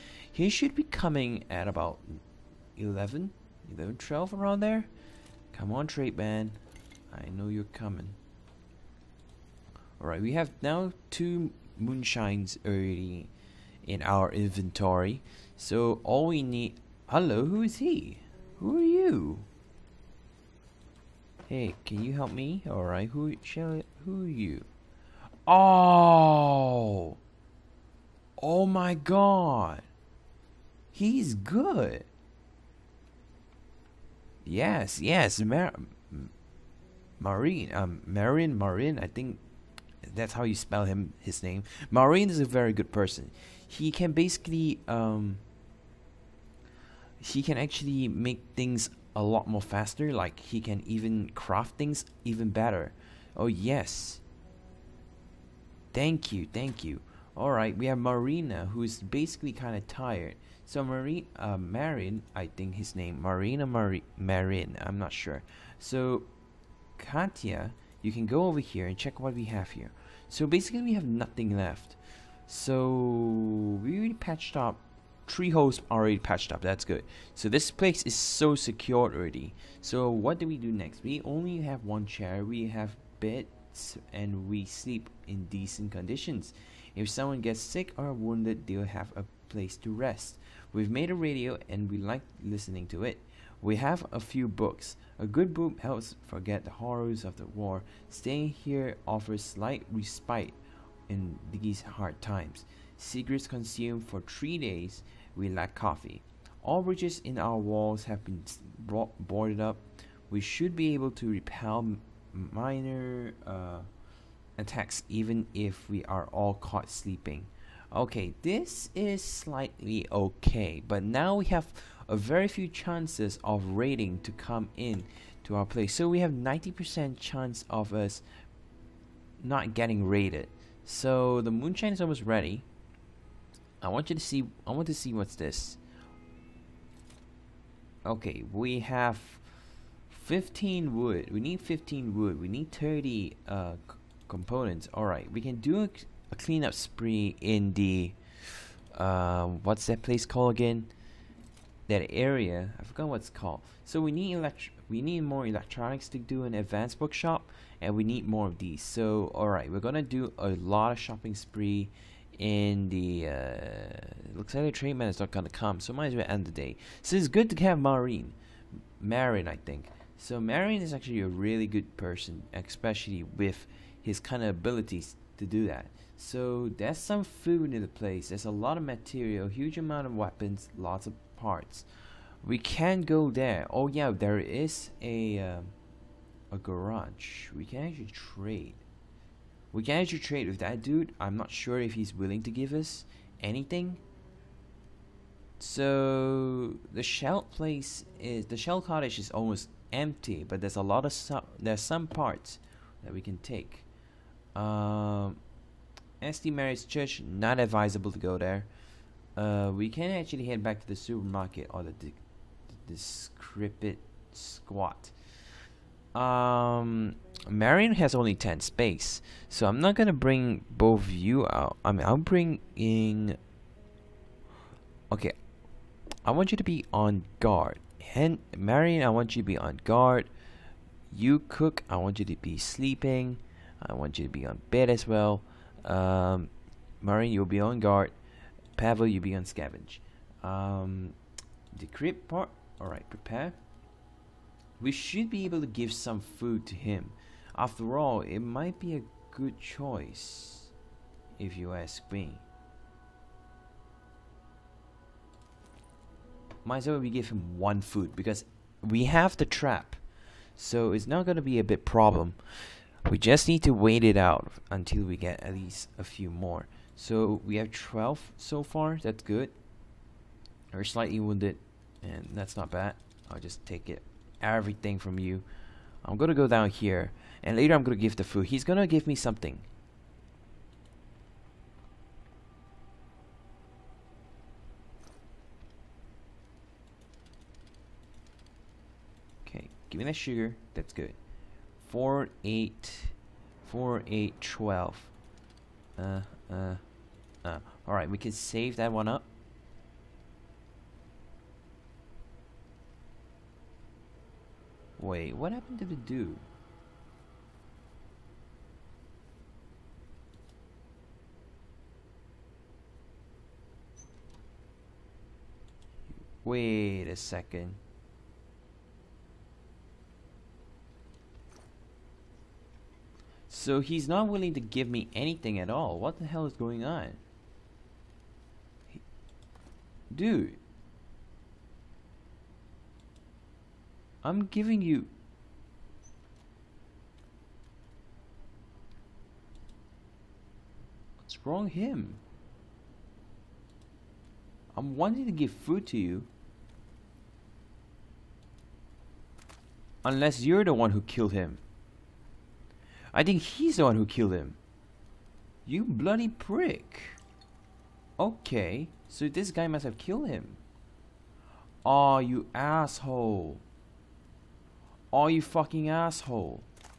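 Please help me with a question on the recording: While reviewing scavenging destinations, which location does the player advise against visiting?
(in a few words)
St. Mary's Church.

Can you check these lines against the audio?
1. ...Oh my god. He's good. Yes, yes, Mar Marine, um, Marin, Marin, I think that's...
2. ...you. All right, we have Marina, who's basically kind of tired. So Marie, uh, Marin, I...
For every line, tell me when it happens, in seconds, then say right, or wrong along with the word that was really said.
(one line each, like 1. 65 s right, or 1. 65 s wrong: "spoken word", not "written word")
1. 28 s right
2. 56 s right.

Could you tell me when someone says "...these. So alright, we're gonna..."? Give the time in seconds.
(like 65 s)
158 s.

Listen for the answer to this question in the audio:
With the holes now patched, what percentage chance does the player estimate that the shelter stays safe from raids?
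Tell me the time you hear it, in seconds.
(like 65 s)
126 s.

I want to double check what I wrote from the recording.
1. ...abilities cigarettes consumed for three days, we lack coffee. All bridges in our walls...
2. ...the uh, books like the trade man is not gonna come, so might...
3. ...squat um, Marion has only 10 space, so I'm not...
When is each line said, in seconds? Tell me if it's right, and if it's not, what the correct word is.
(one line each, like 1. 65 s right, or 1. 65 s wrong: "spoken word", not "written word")
1. 102 s wrong: "times", not "abilities"
2. 162 s wrong: "looks", not "books"
3. 214 s right.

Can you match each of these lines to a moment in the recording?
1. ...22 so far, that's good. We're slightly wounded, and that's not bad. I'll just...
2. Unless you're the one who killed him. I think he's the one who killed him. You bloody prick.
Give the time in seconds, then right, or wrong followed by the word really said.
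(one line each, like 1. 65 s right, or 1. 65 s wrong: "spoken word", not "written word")
1. 267 s wrong: "12", not "22"
2. 350 s right.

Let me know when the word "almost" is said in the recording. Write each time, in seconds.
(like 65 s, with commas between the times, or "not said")
131 s, 199 s.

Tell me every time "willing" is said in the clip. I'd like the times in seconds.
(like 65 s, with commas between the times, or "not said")
192 s, 324 s.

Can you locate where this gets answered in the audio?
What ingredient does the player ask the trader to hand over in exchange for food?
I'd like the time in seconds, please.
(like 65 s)
290 s.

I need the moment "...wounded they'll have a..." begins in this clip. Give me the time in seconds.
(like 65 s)
88 s.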